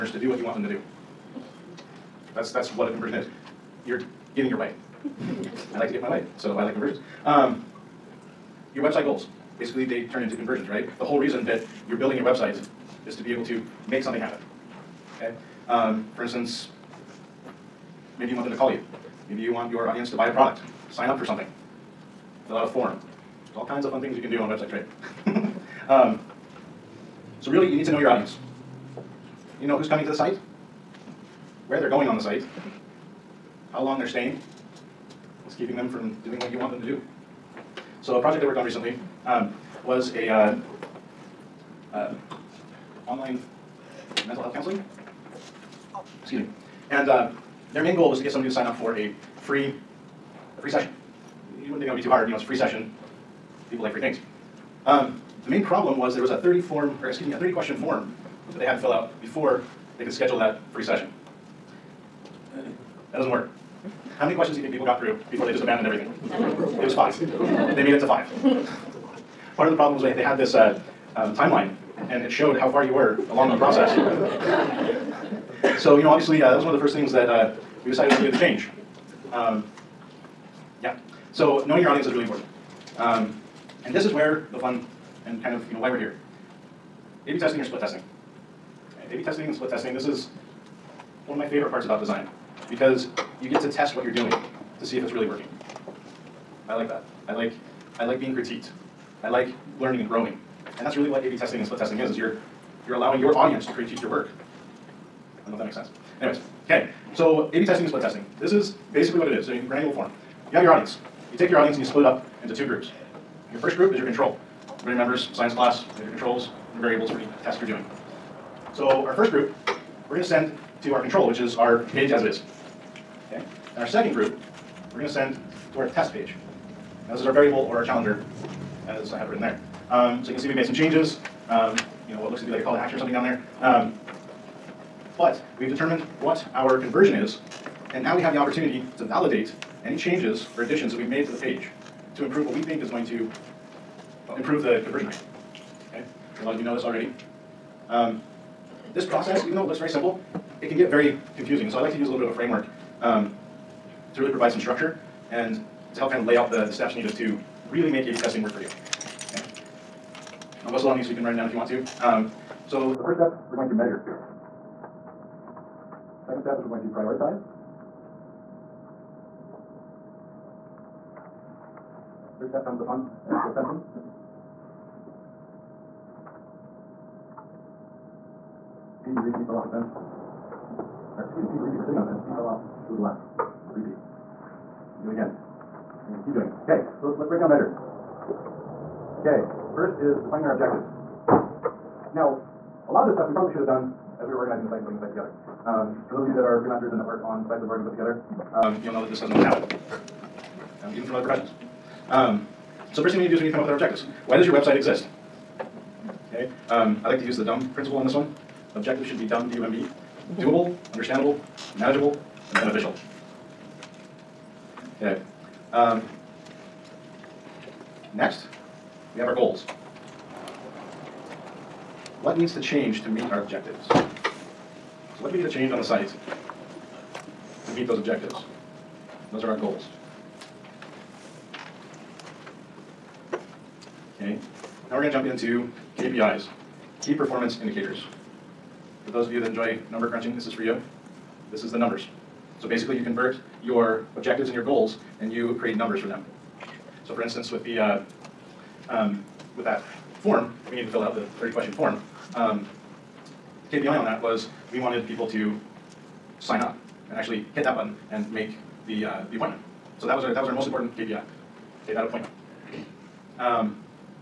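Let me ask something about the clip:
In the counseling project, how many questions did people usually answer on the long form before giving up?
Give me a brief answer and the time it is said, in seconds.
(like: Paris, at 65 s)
5, at 66 s.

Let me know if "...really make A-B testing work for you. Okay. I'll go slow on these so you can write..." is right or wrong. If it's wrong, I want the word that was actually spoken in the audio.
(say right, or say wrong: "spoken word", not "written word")
right.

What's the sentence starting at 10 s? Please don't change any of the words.
The whole reason that you're building your website is to be able to make something happen.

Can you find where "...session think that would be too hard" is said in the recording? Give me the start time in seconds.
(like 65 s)
50 s.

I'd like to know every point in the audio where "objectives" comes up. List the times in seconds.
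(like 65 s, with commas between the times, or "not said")
190 s, 203 s, 208 s, 223 s, 227 s, 244 s.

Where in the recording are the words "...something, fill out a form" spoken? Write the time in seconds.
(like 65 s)
21 s.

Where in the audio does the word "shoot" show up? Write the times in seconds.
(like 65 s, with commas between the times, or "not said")
not said.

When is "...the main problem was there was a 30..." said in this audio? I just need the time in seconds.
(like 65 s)
55 s.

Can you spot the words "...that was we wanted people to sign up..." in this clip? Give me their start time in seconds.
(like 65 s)
254 s.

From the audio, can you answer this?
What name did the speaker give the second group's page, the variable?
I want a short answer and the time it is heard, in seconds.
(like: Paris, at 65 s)
challenger, at 127 s.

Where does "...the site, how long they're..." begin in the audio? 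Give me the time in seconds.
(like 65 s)
32 s.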